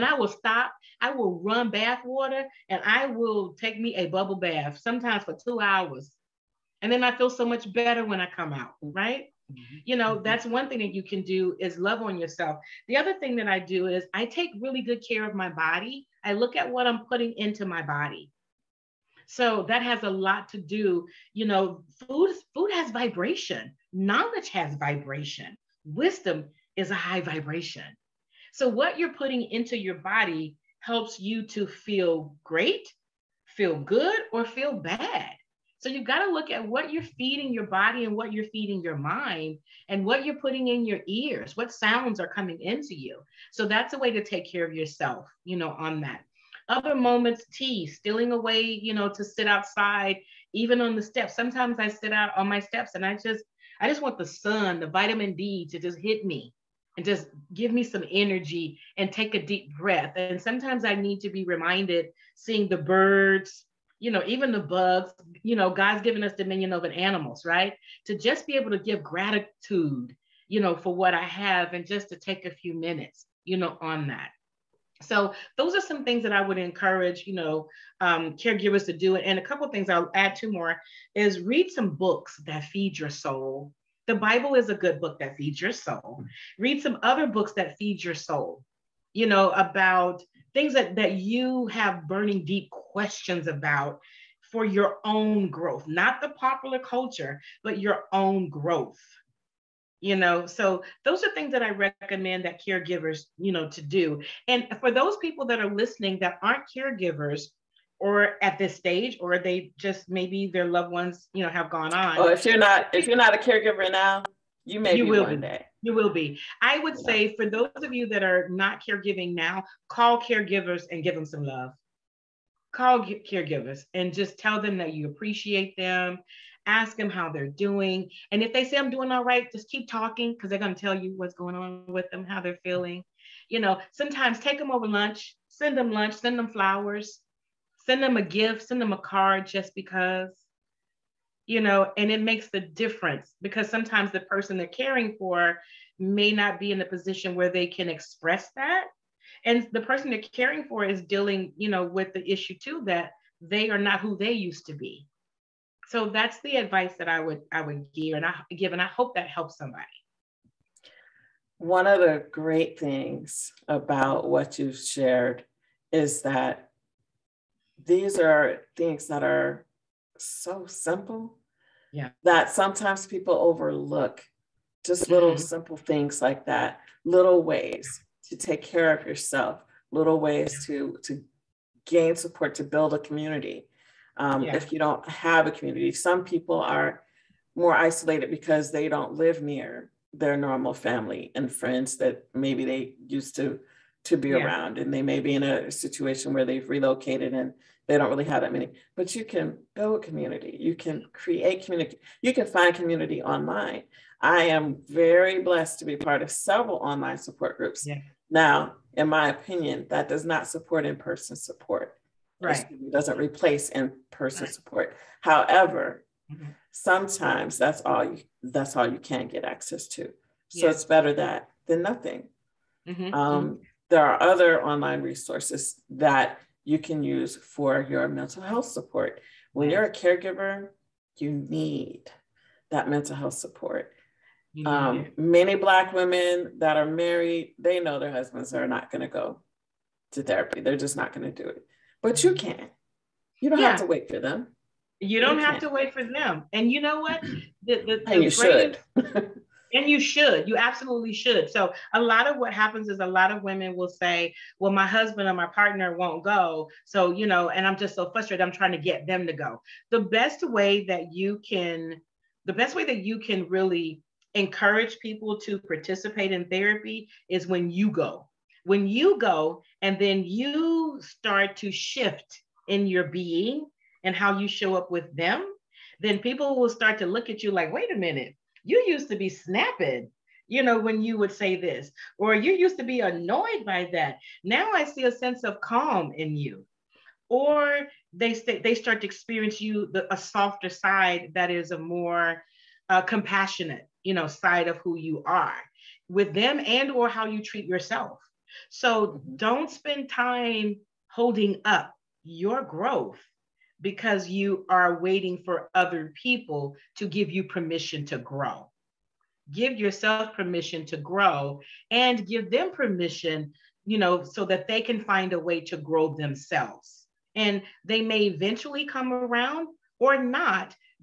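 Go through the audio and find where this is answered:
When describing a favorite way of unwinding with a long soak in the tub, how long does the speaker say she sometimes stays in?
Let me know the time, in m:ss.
0:05.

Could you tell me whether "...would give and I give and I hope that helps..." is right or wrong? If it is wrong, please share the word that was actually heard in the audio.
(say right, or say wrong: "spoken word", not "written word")
right.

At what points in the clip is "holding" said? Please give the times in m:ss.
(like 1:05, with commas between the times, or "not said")
5:01.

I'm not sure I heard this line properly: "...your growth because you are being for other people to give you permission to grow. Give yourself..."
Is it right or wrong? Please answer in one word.
wrong.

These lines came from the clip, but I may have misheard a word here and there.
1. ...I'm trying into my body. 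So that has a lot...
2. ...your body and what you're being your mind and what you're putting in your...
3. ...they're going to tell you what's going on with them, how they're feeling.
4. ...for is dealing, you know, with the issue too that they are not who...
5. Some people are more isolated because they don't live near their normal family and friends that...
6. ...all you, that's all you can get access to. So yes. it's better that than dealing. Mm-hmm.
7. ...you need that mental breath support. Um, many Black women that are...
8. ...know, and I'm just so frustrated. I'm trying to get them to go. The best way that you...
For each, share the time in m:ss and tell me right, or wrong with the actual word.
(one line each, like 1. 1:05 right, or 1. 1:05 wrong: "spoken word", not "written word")
1. 0:16 wrong: "putting", not "trying"
2. 0:37 wrong: "feeding", not "being"
3. 2:10 right
4. 2:30 right
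5. 3:05 right
6. 3:37 wrong: "nothing", not "dealing"
7. 3:51 wrong: "health", not "breath"
8. 4:17 right.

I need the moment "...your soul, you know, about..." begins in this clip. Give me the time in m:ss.
1:28.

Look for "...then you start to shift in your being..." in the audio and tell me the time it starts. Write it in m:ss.
4:29.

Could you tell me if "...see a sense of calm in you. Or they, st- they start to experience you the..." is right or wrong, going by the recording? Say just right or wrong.
right.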